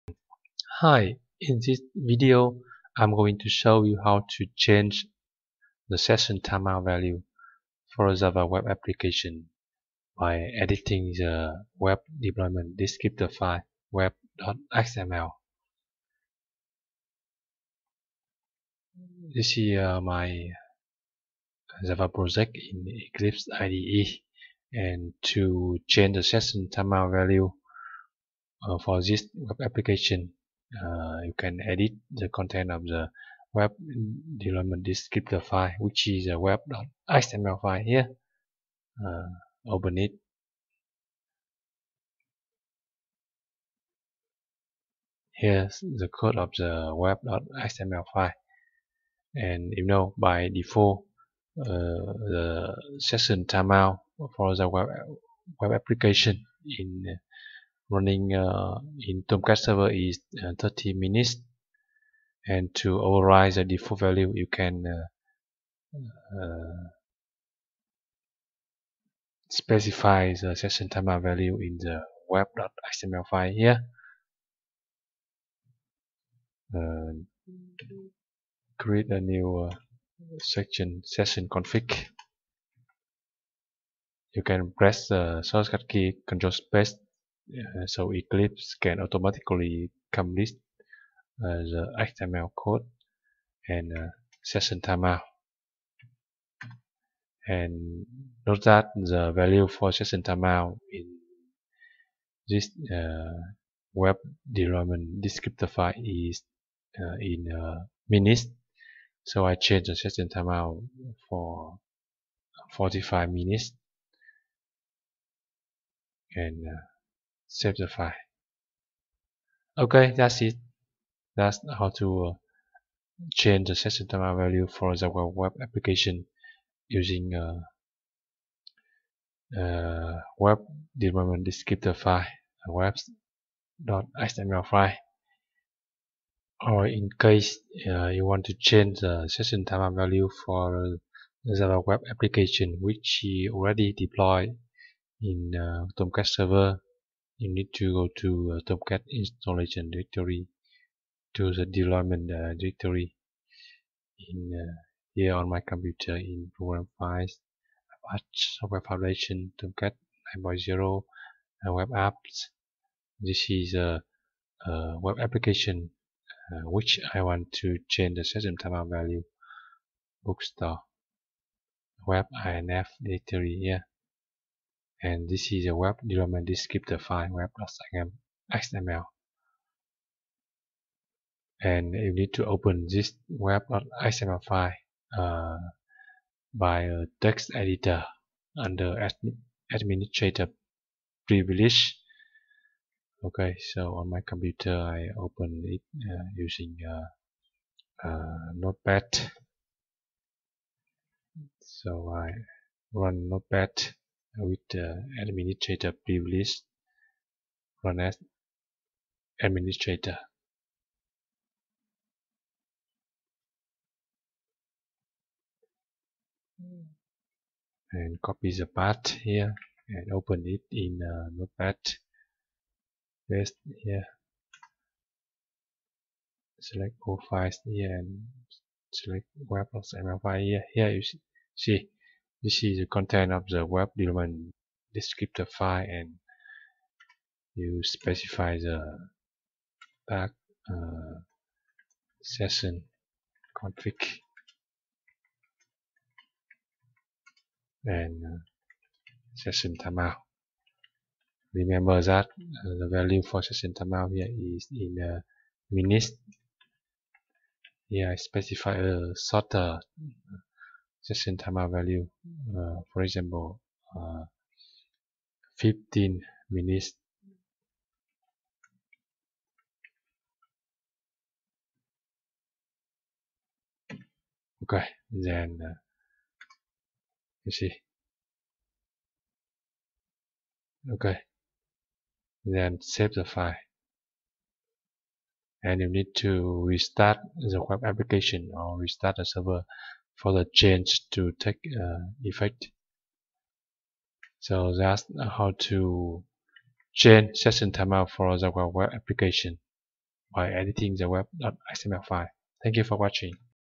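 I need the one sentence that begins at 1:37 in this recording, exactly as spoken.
And note that the value for session timeout in this uh, web development descriptor file is uh, in uh, minutes.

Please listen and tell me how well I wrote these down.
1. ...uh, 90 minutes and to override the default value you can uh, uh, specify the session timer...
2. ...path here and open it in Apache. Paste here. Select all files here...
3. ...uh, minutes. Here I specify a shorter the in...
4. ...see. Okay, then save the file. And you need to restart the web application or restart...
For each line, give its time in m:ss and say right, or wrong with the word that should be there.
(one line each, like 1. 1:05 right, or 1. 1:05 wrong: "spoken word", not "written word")
1. 1:00 wrong: "30", not "90"
2. 3:38 wrong: "Notepad", not "Apache"
3. 4:14 right
4. 4:37 right.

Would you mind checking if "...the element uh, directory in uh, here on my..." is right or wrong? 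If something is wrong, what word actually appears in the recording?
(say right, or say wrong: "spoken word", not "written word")
wrong: "deployment", not "element".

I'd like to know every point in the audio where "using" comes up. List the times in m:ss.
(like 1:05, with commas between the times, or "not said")
2:06, 3:16.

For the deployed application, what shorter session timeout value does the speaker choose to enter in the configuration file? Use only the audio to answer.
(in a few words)
15 minutes.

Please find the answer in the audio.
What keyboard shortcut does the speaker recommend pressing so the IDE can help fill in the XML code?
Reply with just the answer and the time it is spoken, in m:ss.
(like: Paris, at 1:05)
Control space, at 1:26.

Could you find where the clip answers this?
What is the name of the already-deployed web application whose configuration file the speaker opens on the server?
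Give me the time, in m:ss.
2:50.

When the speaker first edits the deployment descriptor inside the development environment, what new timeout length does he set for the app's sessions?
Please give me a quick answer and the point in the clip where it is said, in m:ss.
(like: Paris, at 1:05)
45 minutes, at 1:52.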